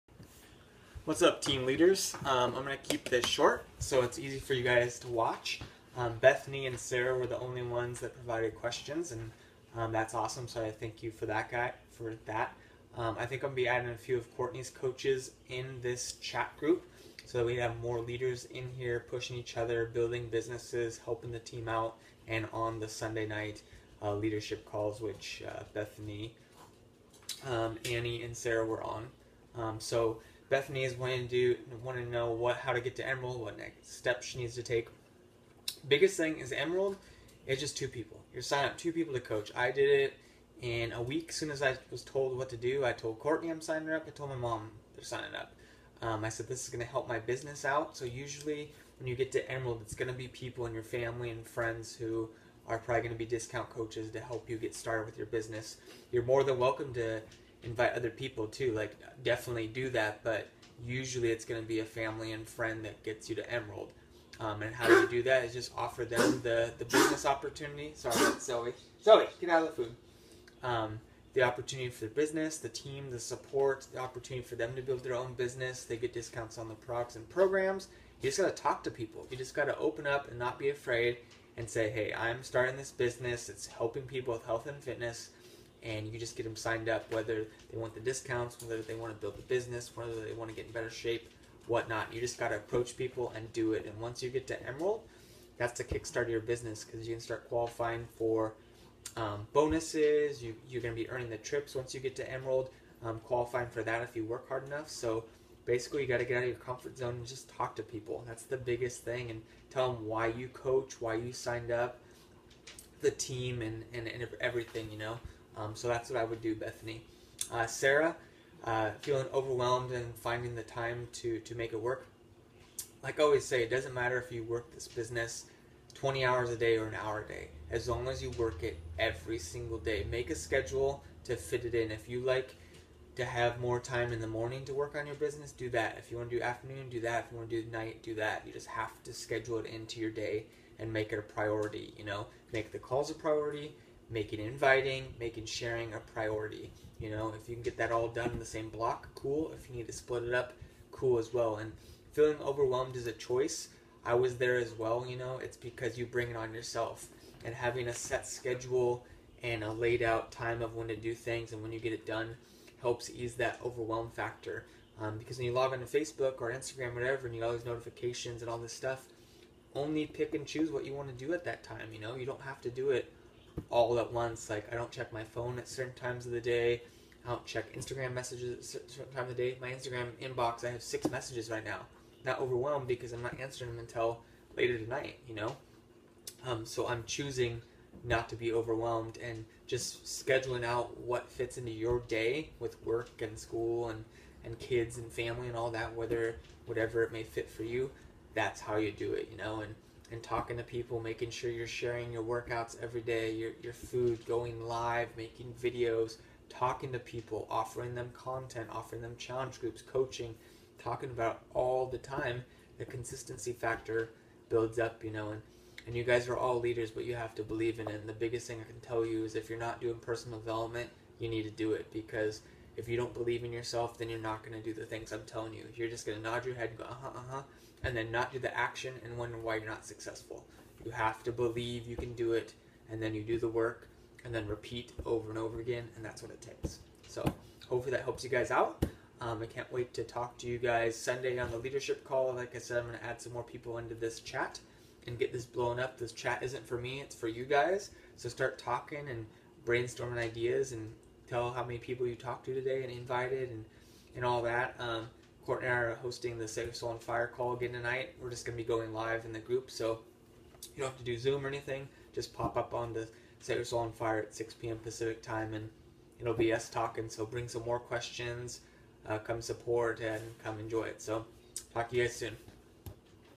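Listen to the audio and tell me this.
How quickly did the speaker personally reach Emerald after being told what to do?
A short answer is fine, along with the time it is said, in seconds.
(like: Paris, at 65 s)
In a week, at 40 s.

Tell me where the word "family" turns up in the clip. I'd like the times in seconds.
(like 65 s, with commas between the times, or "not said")
50 s, 61 s, 195 s.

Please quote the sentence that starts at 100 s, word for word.
You, you're going to be earning the trips once you get to Emerald, um, qualifying for that if you work hard enough.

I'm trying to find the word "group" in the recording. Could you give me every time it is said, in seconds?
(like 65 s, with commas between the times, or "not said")
16 s, 209 s, 259 s.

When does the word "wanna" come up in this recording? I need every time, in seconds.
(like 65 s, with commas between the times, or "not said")
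not said.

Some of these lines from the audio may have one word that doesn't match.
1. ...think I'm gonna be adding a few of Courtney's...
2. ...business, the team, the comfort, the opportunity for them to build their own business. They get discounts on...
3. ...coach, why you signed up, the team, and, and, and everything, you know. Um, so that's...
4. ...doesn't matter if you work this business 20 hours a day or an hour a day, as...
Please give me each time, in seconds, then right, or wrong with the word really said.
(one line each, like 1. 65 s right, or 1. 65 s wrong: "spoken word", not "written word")
1. 13 s right
2. 72 s wrong: "support", not "comfort"
3. 110 s right
4. 123 s right.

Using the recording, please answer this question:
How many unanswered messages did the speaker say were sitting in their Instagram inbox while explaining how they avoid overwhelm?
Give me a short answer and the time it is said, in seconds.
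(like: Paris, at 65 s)
6, at 180 s.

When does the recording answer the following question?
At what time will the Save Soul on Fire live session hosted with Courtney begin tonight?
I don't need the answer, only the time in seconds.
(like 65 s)
264 s.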